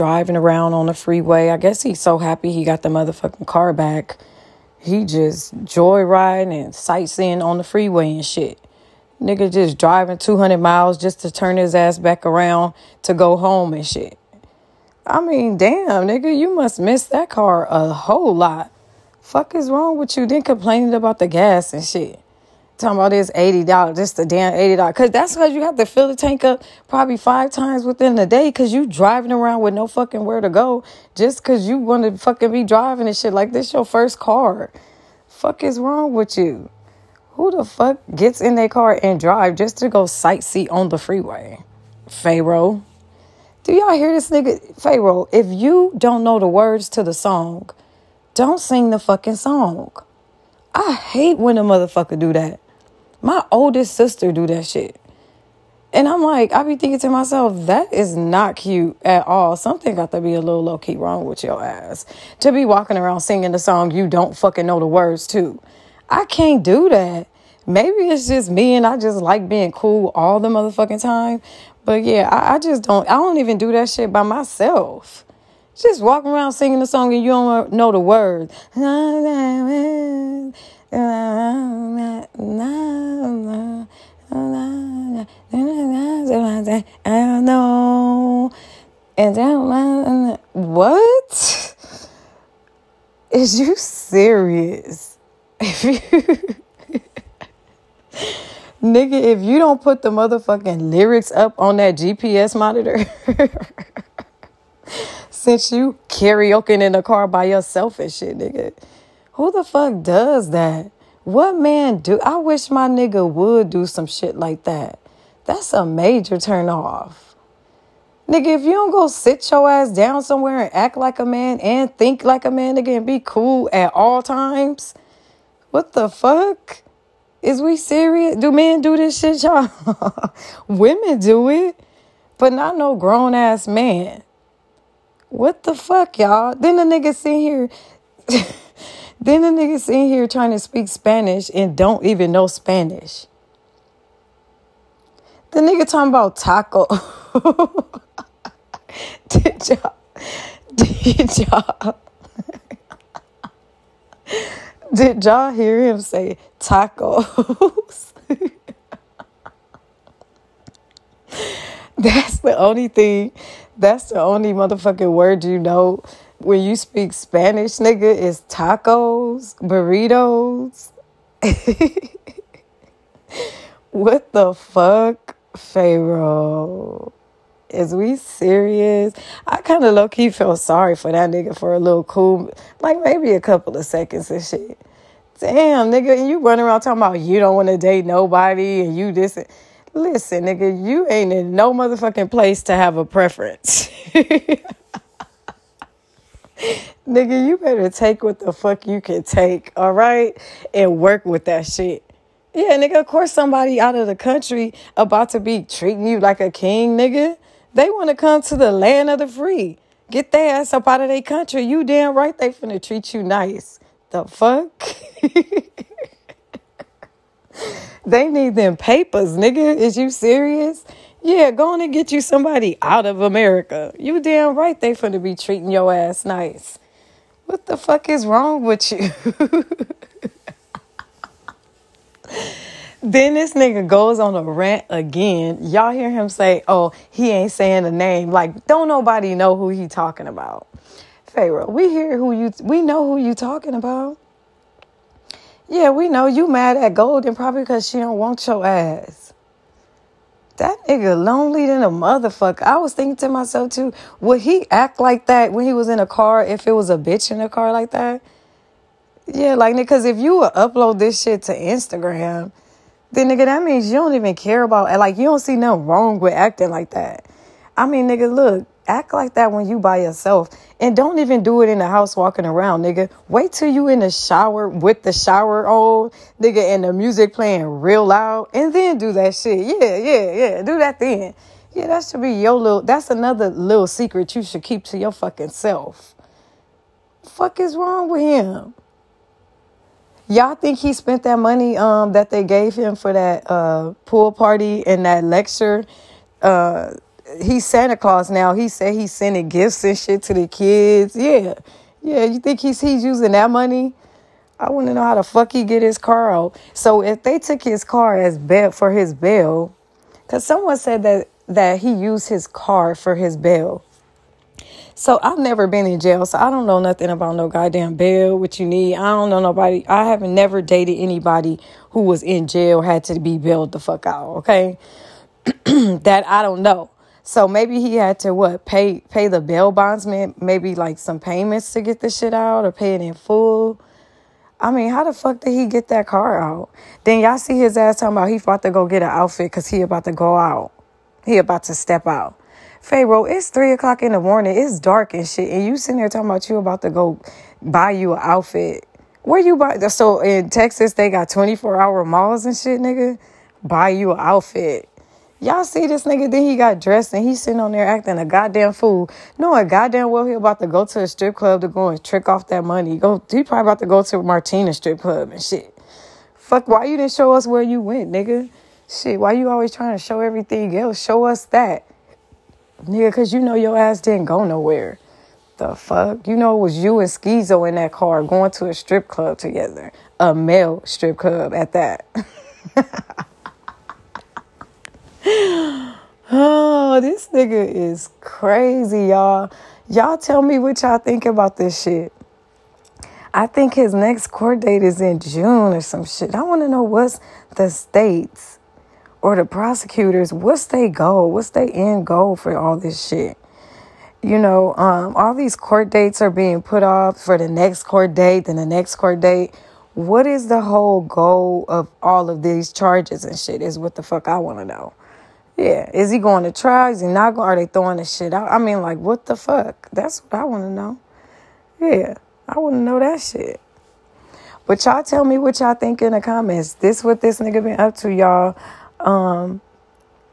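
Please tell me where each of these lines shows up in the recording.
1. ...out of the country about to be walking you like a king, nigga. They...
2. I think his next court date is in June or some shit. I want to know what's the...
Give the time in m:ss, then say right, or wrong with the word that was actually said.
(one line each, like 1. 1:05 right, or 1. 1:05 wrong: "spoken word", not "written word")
1. 3:23 wrong: "treating", not "walking"
2. 6:33 right.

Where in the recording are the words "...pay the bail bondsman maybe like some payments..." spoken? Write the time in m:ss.
5:29.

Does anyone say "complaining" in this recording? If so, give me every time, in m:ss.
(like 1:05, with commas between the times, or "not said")
0:20.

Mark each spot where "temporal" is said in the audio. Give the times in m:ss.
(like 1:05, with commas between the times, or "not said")
not said.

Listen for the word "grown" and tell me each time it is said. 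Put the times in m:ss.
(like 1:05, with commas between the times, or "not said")
2:12.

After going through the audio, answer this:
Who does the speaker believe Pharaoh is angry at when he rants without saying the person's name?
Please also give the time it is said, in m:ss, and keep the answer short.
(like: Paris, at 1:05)
Golden, at 4:06.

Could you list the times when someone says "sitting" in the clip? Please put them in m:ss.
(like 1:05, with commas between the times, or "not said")
5:45, 5:57.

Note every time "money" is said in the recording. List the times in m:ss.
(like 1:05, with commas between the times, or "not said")
4:51, 5:03, 6:02.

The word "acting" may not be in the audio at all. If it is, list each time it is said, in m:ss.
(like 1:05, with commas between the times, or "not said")
4:26, 5:57.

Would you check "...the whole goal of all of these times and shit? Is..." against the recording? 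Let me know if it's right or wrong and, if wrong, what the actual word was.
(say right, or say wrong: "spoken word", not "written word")
wrong: "charges", not "times".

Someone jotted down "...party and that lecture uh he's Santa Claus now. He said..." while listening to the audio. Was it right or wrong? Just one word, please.
right.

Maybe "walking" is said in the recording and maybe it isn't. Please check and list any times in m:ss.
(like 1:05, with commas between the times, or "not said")
1:02, 1:16, 4:32.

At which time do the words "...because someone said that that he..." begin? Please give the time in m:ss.
5:10.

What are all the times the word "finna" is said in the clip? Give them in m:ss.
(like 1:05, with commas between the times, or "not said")
3:32, 3:44.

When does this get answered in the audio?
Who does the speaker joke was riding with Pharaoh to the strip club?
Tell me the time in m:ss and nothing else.
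6:17.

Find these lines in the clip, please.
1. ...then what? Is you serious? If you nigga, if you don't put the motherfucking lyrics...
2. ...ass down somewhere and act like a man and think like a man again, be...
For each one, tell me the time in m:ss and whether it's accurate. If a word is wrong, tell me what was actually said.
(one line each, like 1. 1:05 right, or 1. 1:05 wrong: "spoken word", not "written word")
1. 1:29 right
2. 1:59 right.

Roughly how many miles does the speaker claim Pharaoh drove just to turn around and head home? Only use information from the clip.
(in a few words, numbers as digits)
200.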